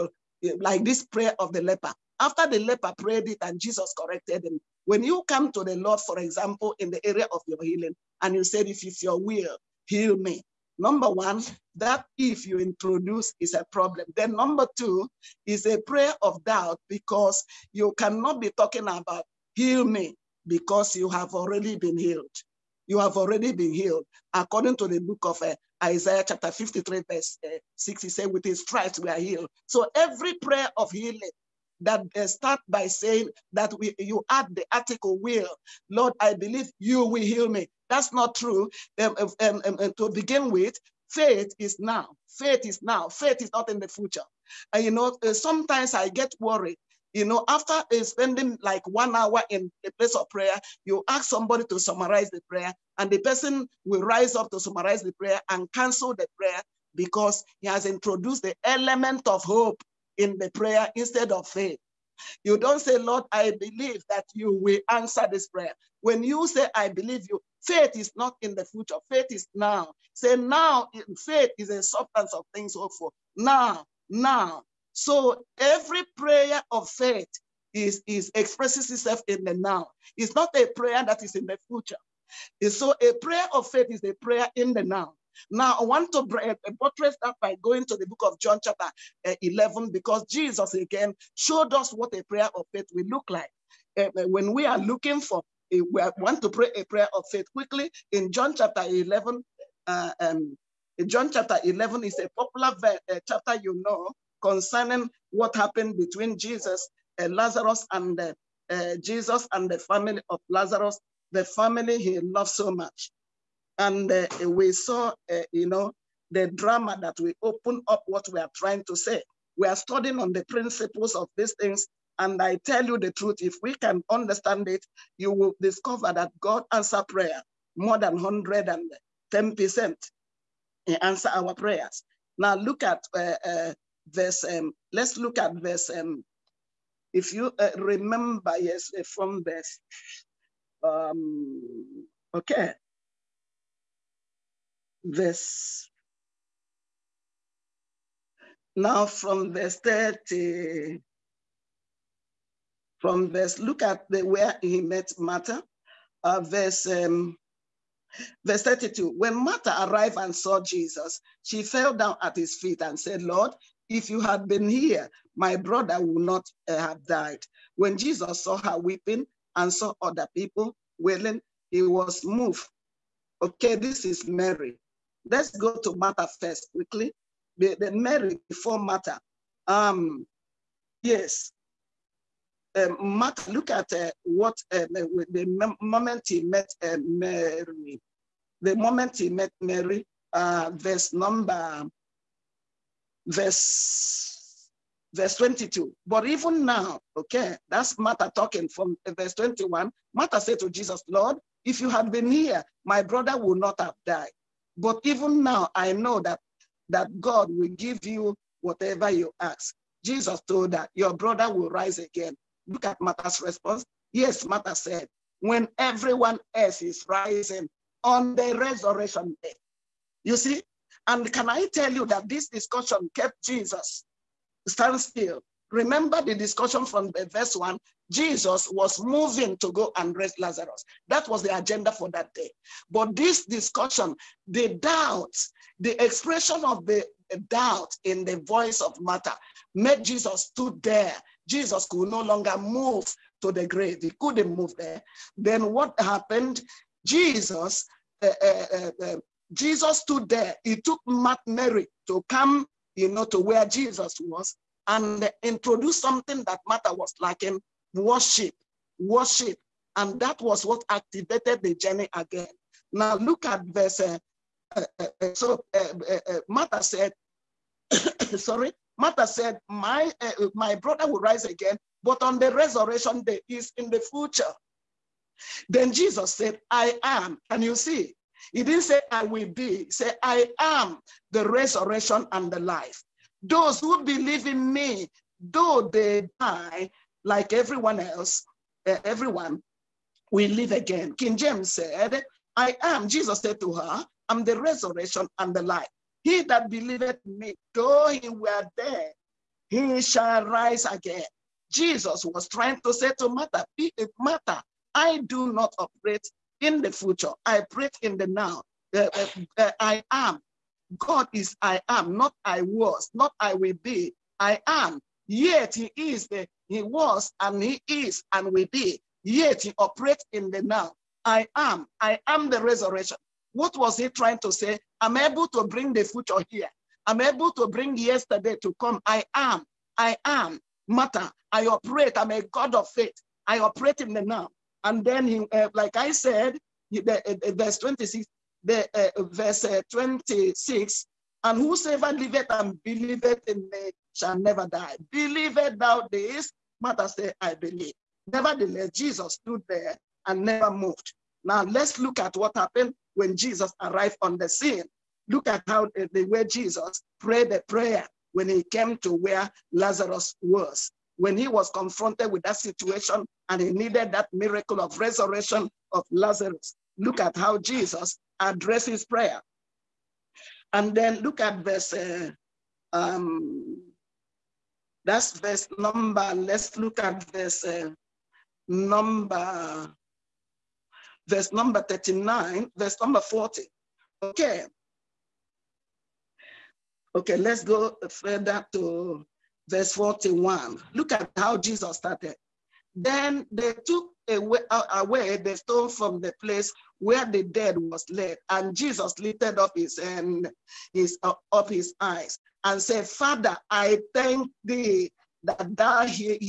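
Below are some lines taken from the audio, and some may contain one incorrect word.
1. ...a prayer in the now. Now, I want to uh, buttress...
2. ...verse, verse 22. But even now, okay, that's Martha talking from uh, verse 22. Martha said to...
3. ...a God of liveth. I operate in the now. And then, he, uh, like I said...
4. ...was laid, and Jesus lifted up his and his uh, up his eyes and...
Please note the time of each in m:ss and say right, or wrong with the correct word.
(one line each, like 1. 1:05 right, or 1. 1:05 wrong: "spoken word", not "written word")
1. 1:24 right
2. 3:13 wrong: "21", not "22"
3. 5:32 wrong: "faith", not "liveth"
4. 6:37 right.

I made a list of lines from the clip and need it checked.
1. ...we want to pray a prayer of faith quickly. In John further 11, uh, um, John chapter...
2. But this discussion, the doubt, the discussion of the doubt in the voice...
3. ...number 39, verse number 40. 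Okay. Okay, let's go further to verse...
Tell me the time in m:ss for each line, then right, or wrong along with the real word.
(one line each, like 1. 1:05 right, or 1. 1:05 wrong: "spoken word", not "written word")
1. 1:35 wrong: "chapter", not "further"
2. 3:52 wrong: "expression", not "discussion"
3. 6:21 right.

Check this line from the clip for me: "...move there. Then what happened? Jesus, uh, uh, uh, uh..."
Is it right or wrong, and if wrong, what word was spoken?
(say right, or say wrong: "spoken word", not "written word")
right.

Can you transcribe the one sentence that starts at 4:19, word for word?
And that was what activated the journey again.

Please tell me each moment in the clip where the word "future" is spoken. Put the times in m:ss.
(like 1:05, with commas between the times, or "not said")
0:43, 1:08, 1:21, 4:34, 5:06, 5:26.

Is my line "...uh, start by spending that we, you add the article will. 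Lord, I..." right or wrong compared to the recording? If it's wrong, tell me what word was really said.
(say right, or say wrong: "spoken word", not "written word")
wrong: "saying", not "spending".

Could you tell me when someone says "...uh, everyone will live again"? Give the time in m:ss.
4:48.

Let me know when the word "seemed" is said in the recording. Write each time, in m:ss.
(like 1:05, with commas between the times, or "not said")
not said.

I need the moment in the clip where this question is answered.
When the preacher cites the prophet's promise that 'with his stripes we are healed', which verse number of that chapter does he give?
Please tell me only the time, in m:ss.
0:27.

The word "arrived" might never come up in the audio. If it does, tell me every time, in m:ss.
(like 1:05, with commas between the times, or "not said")
2:39, 5:53.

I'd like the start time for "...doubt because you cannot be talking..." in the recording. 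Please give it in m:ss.
0:16.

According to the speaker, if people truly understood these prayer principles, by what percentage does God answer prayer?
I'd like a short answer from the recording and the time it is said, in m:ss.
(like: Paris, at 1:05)
110%, at 2:08.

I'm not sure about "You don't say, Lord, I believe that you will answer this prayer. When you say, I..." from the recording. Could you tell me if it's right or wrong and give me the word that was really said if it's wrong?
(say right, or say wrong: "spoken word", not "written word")
right.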